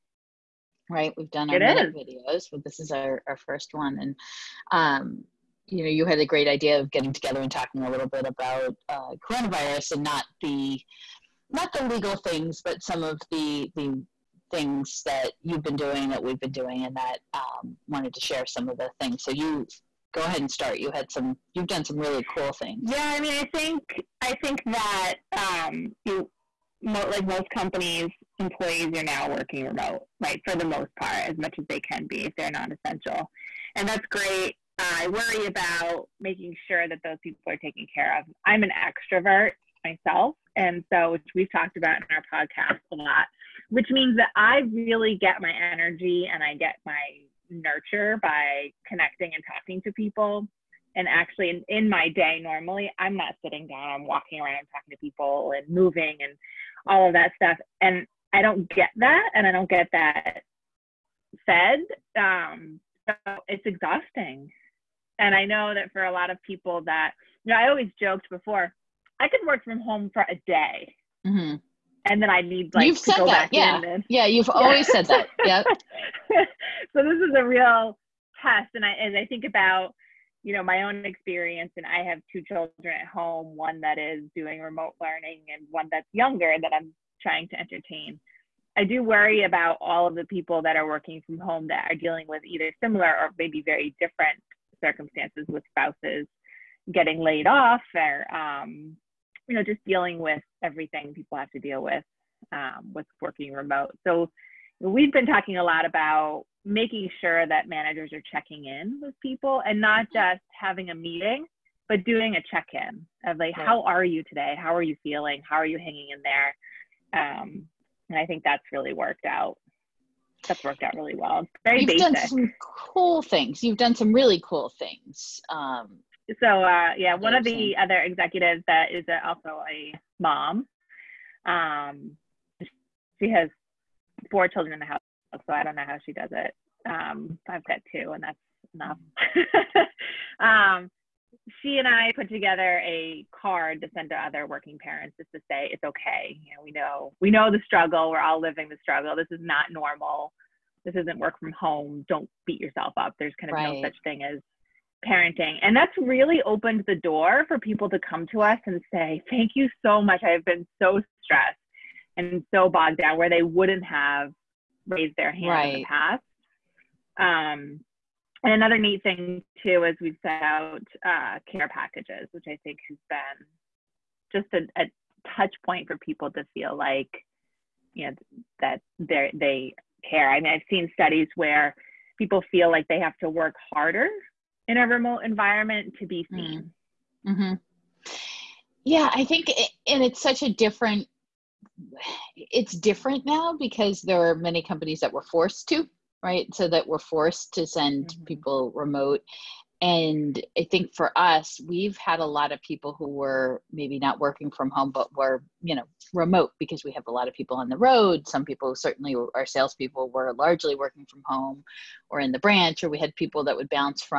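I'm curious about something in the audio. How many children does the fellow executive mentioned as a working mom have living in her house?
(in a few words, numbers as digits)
4.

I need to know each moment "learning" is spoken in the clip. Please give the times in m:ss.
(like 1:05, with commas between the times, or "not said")
1:25.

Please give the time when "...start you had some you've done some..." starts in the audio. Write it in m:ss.
0:20.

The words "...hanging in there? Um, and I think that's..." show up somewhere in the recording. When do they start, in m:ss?
1:55.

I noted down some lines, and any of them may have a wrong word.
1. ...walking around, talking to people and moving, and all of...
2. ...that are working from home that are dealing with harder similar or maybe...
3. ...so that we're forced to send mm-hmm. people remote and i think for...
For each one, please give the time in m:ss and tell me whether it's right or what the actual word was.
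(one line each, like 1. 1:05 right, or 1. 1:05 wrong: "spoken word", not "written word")
1. 0:54 right
2. 1:30 wrong: "either", not "harder"
3. 3:16 right.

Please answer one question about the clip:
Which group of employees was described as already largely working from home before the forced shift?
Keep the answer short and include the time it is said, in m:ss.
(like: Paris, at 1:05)
salespeople, at 3:29.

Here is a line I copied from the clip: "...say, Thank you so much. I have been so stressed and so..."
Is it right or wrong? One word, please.
right.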